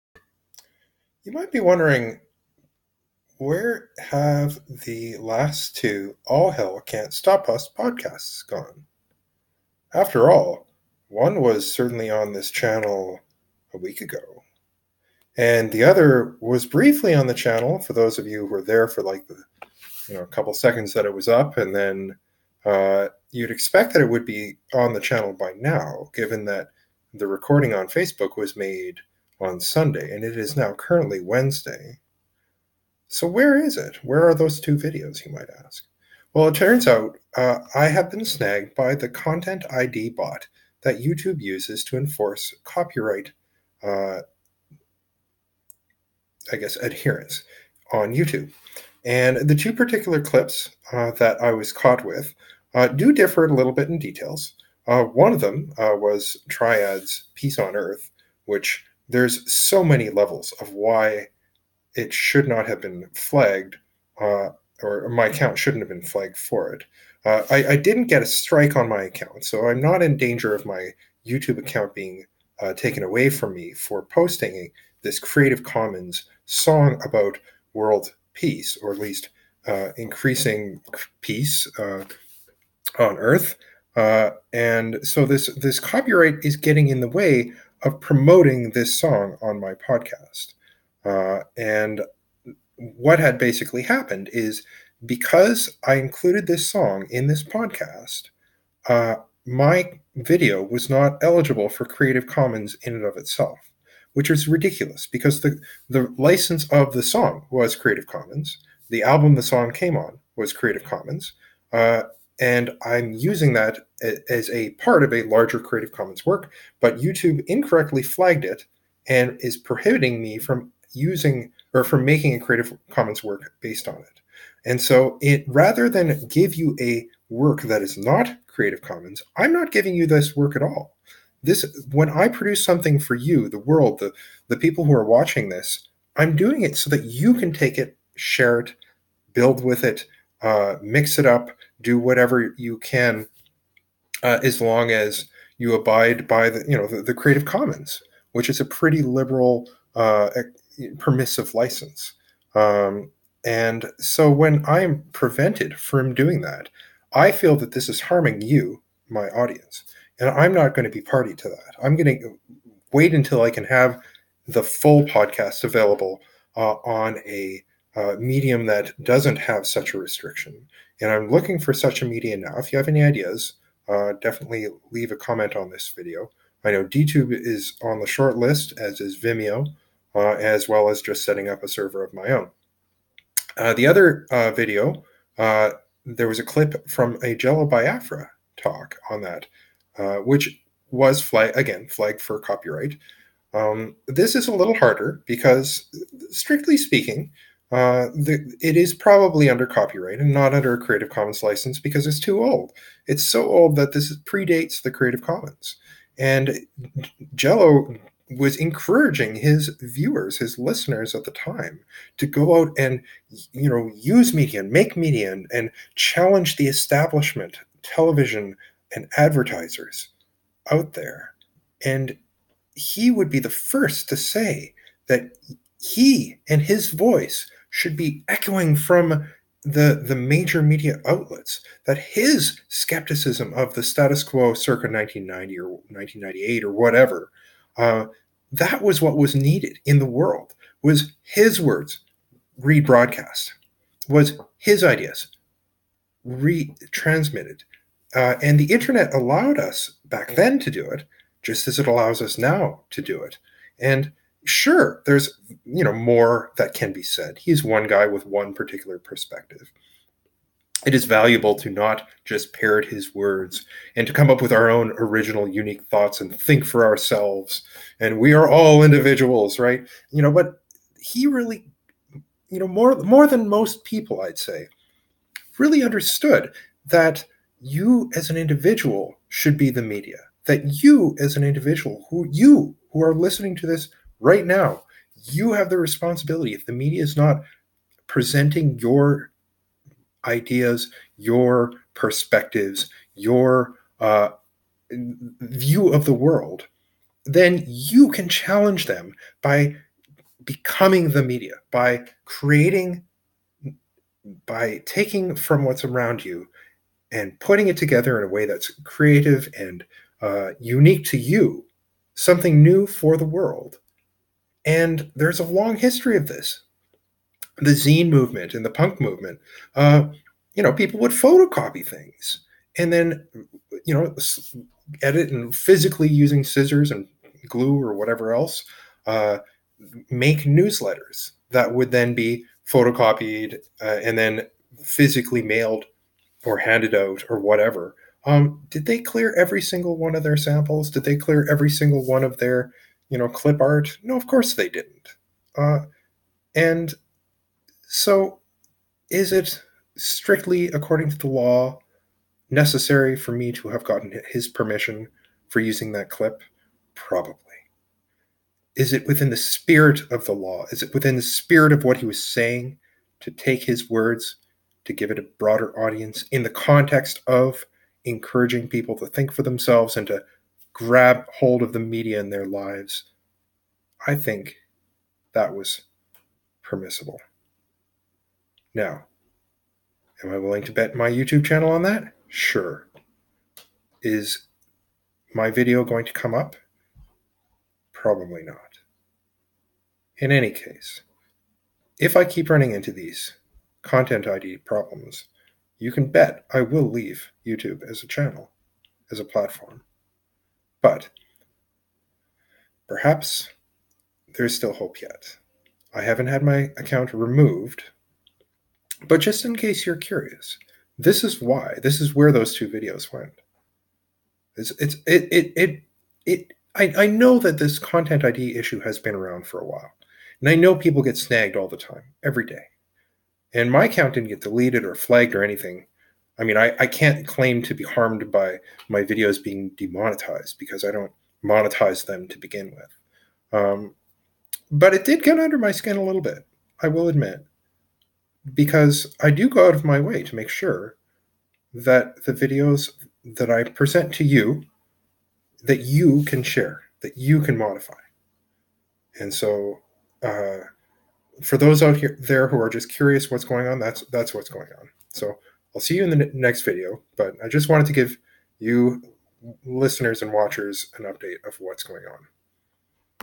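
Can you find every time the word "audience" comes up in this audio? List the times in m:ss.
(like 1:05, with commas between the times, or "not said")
2:39, 6:05.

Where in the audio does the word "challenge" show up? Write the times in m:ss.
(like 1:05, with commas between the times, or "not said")
3:35, 4:58.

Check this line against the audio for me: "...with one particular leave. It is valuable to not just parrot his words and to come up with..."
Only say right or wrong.
wrong.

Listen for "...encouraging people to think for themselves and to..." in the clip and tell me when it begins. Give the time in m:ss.
6:08.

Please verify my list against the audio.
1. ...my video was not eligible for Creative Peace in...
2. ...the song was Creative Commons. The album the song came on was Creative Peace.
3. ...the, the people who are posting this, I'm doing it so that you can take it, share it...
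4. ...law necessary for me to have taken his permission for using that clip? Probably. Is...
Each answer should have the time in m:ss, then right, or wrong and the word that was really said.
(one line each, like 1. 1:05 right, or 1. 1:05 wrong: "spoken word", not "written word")
1. 1:39 wrong: "Commons", not "Peace"
2. 1:46 wrong: "Commons", not "Peace"
3. 2:13 wrong: "watching", not "posting"
4. 5:51 wrong: "gotten", not "taken".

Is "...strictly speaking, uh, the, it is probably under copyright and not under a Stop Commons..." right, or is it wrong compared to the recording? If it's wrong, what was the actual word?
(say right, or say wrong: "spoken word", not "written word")
wrong: "Creative", not "Stop".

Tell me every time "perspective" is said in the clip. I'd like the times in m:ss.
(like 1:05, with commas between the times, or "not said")
4:18, 4:51.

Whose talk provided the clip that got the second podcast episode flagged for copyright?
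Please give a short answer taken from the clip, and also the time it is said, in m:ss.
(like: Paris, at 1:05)
Jello Biafra, at 3:07.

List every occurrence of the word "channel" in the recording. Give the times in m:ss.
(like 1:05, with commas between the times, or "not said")
0:12, 0:17, 0:24, 6:21, 6:38.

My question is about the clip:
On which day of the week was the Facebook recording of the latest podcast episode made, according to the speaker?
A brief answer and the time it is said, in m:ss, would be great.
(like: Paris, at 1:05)
Sunday, at 0:29.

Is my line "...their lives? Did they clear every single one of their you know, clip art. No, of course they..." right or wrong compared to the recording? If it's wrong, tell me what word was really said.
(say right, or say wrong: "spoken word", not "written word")
wrong: "samples", not "lives".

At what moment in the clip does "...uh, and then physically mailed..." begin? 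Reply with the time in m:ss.
5:33.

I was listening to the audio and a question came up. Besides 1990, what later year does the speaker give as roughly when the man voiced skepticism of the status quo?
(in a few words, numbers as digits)
1998.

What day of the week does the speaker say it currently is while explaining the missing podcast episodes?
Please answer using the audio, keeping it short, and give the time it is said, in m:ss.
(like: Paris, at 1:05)
Wednesday, at 0:31.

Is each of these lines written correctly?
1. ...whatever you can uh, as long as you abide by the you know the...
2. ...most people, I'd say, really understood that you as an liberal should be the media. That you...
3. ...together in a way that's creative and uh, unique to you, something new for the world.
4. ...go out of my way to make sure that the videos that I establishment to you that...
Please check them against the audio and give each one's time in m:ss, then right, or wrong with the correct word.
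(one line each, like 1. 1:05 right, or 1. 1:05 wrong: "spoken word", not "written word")
1. 2:21 right
2. 4:33 wrong: "individual", not "liberal"
3. 5:07 right
4. 7:19 wrong: "present", not "establishment".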